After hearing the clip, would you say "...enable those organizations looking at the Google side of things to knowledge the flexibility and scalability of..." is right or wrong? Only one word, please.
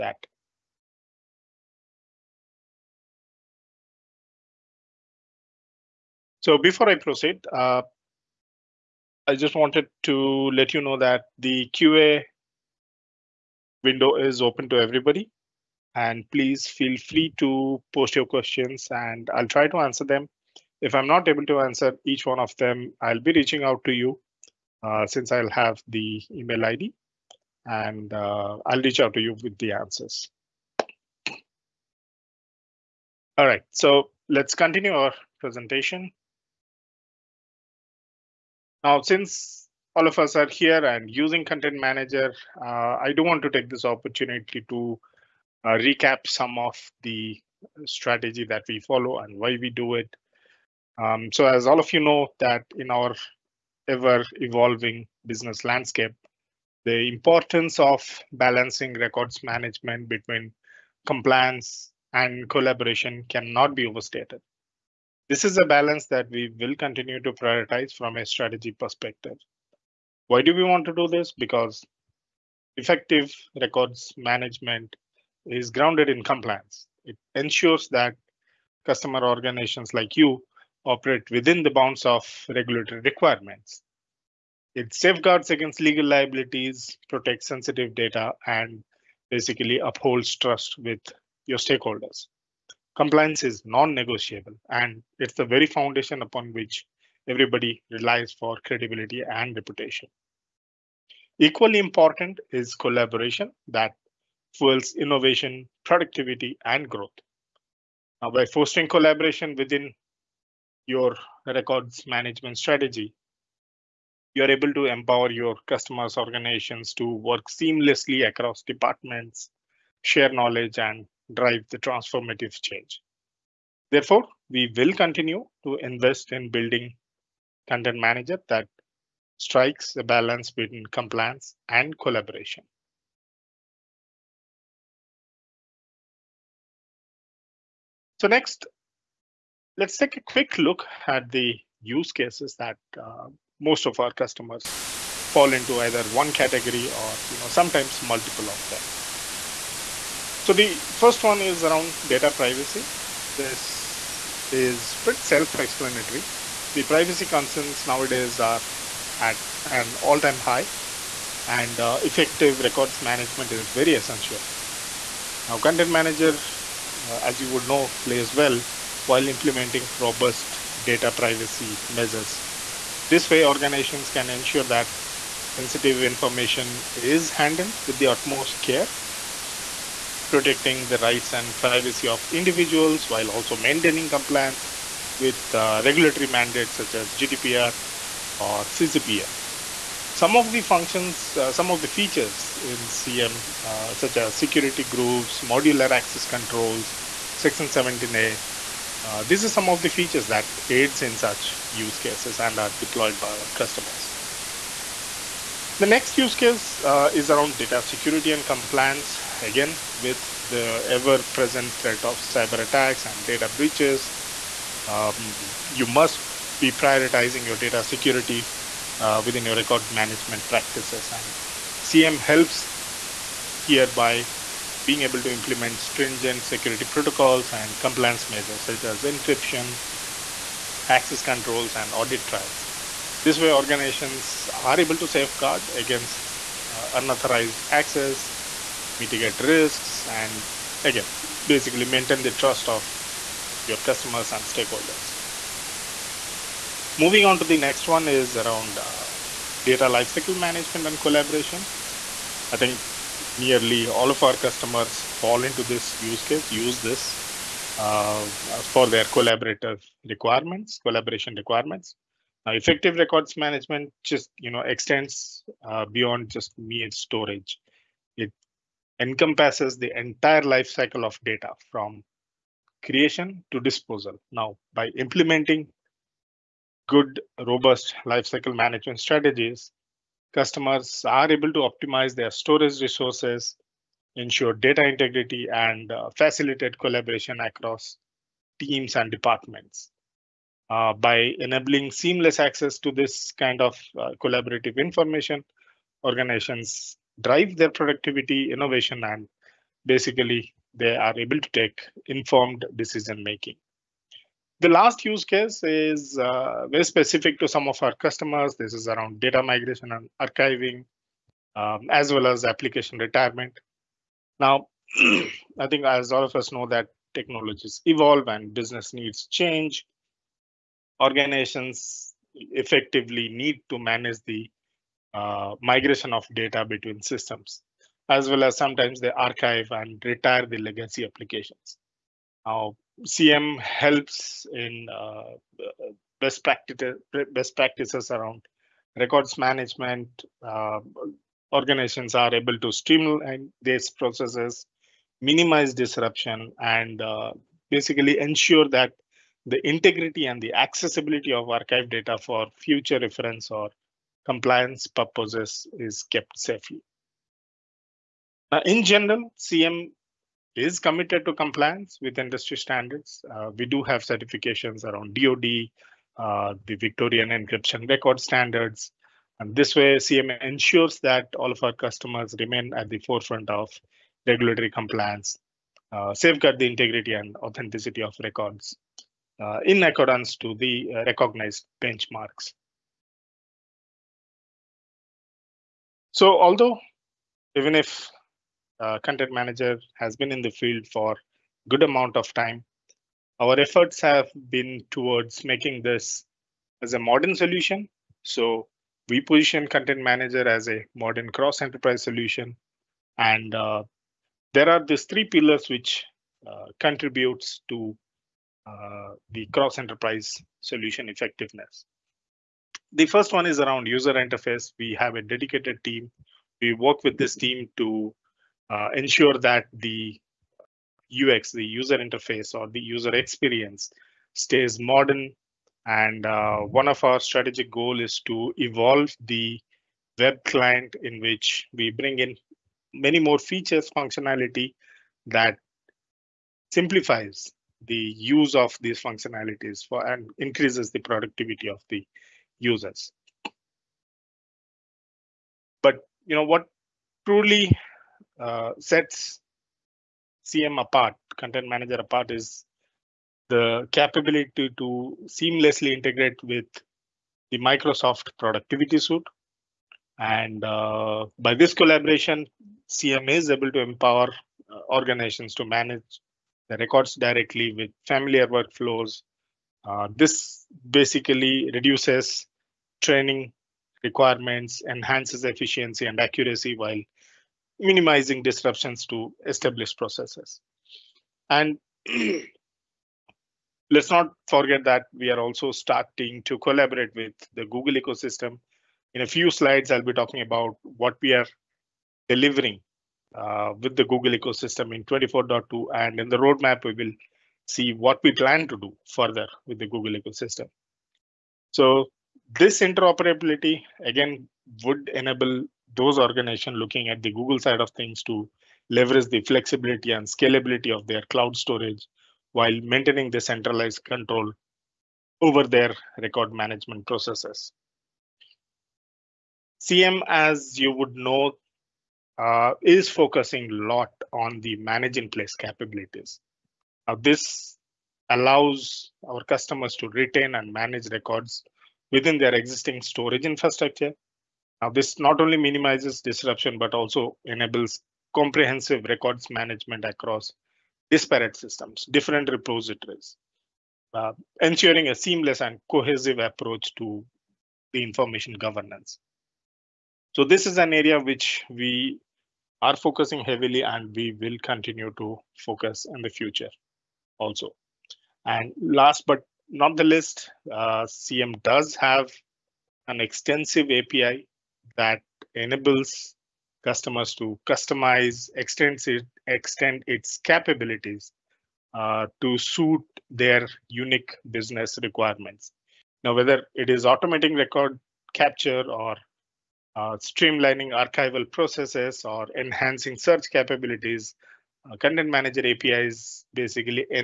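wrong.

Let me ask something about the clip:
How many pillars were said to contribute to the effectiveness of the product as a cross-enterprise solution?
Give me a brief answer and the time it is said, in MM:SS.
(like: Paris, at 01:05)
3, at 06:45.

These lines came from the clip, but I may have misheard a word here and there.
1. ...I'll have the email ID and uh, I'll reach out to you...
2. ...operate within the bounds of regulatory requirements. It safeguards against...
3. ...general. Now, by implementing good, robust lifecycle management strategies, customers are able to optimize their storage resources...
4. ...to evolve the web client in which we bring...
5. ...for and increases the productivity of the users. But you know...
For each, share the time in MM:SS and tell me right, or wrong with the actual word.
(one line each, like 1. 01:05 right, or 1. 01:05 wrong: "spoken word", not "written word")
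1. 00:25 right
2. 01:20 right
3. 04:33 wrong: "disposal", not "general"
4. 07:08 right
5. 07:19 right.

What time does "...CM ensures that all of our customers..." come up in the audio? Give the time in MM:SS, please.
06:09.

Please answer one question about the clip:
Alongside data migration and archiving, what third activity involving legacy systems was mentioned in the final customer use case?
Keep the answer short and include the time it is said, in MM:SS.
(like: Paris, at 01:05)
application retirement, at 05:12.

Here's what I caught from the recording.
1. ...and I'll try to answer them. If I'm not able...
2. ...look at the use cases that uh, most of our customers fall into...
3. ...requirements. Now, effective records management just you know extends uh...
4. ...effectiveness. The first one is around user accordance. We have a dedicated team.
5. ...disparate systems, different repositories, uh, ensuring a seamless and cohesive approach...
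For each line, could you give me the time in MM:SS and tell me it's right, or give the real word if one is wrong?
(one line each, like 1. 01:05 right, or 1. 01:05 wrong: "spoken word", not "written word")
1. 00:18 right
2. 02:20 right
3. 04:21 right
4. 06:51 wrong: "interface", not "accordance"
5. 09:01 right.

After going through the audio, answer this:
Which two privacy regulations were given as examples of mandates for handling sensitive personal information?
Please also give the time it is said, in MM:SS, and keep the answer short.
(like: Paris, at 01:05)
GDPR or CCPA, at 03:07.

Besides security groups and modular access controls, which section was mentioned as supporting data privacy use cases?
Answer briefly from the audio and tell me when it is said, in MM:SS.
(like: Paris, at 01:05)
Section 17A, at 03:17.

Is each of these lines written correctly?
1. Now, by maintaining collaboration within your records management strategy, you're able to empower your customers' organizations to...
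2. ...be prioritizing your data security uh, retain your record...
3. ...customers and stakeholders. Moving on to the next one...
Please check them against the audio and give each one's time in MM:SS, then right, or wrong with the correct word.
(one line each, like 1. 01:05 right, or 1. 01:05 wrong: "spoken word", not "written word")
1. 01:48 wrong: "fostering", not "maintaining"
2. 03:36 wrong: "within", not "retain"
3. 04:03 right.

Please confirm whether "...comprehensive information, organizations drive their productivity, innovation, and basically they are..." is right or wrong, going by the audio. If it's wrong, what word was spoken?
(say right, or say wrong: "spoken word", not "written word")
wrong: "collaborative", not "comprehensive".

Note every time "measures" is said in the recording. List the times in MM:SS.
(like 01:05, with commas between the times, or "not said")
02:51, 03:48.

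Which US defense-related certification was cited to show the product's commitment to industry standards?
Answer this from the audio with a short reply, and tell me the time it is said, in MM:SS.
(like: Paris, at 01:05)
DoD, at 06:05.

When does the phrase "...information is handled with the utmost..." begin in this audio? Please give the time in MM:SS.
02:55.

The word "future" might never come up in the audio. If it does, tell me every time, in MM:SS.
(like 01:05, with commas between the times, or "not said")
05:52, 09:16.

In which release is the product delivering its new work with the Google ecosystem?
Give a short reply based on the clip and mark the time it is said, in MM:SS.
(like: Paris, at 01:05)
24.2, at 08:15.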